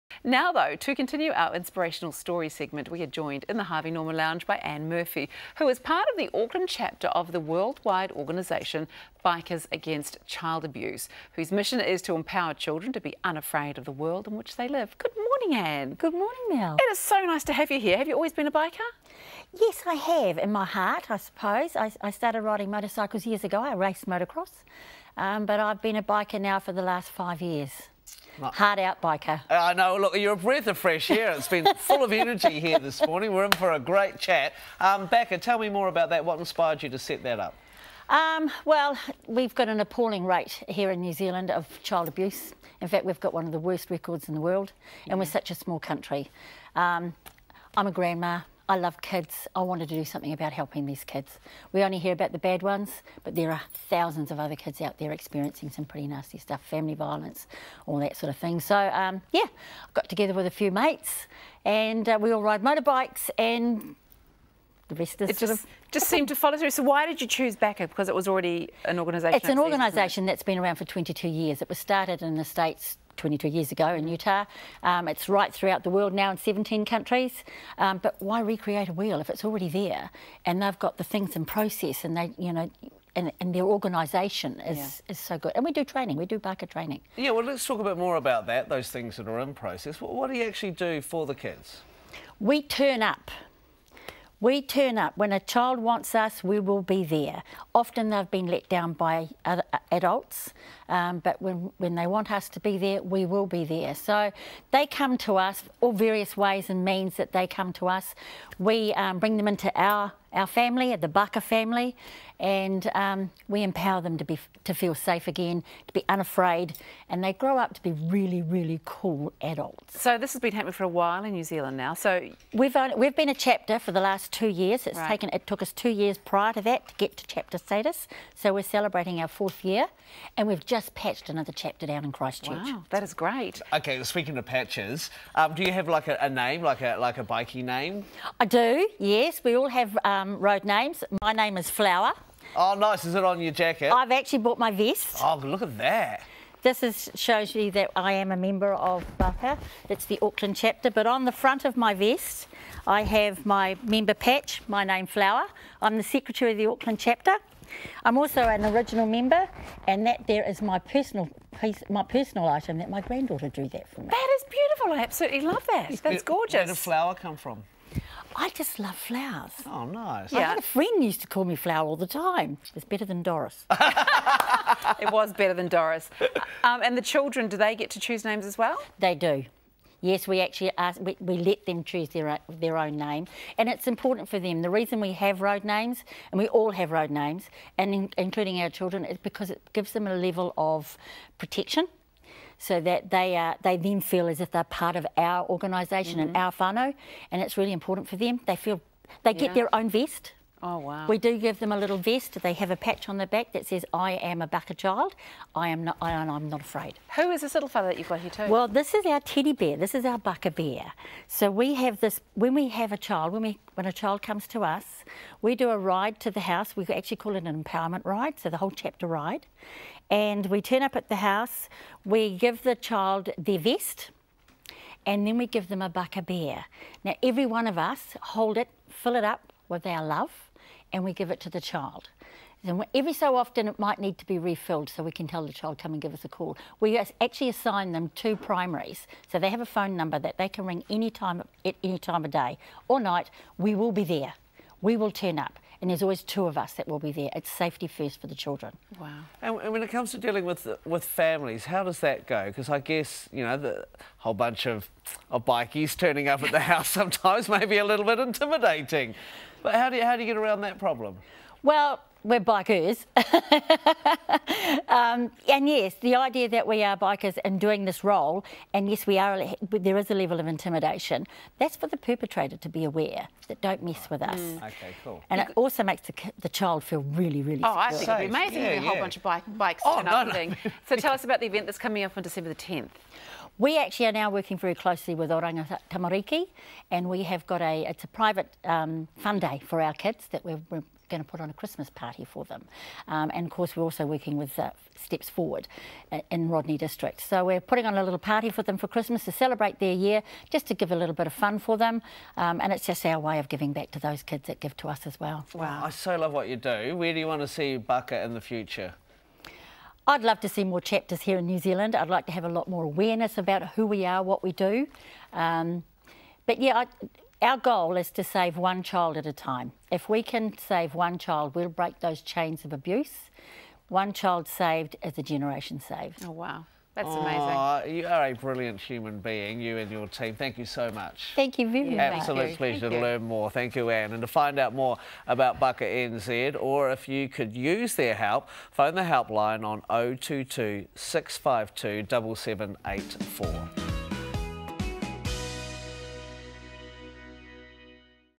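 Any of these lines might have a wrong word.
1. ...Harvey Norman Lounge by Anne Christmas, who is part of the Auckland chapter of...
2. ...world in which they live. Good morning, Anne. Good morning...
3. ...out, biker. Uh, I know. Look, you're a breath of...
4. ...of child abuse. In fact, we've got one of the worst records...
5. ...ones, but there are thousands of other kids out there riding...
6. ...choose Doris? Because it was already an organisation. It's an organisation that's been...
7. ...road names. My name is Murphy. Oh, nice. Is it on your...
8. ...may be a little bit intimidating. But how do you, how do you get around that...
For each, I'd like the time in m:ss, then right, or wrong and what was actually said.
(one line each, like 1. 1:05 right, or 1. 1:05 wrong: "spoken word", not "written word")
1. 0:03 wrong: "Murphy", not "Christmas"
2. 0:13 right
3. 0:28 right
4. 0:41 right
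5. 0:52 wrong: "experiencing", not "riding"
6. 1:07 wrong: "BACA", not "Doris"
7. 2:20 wrong: "Flower", not "Murphy"
8. 4:17 right.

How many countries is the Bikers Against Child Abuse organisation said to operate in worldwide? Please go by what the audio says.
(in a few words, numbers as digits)
17.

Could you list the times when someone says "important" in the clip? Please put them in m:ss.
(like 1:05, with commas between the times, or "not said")
3:03, 3:17.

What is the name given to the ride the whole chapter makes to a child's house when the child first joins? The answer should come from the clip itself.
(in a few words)
empowerment ride.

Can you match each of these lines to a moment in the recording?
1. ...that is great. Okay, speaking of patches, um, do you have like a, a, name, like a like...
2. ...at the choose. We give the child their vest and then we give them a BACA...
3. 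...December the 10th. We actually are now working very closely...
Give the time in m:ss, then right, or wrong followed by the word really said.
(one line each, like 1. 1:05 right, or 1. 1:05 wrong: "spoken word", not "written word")
1. 2:12 right
2. 3:40 wrong: "house", not "choose"
3. 4:42 right.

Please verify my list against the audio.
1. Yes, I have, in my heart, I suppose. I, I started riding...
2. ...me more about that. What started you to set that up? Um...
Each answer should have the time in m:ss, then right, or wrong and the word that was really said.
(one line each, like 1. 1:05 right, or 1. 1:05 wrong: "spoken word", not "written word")
1. 0:19 right
2. 0:35 wrong: "inspired", not "started".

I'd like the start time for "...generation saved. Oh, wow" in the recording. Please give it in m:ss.
5:25.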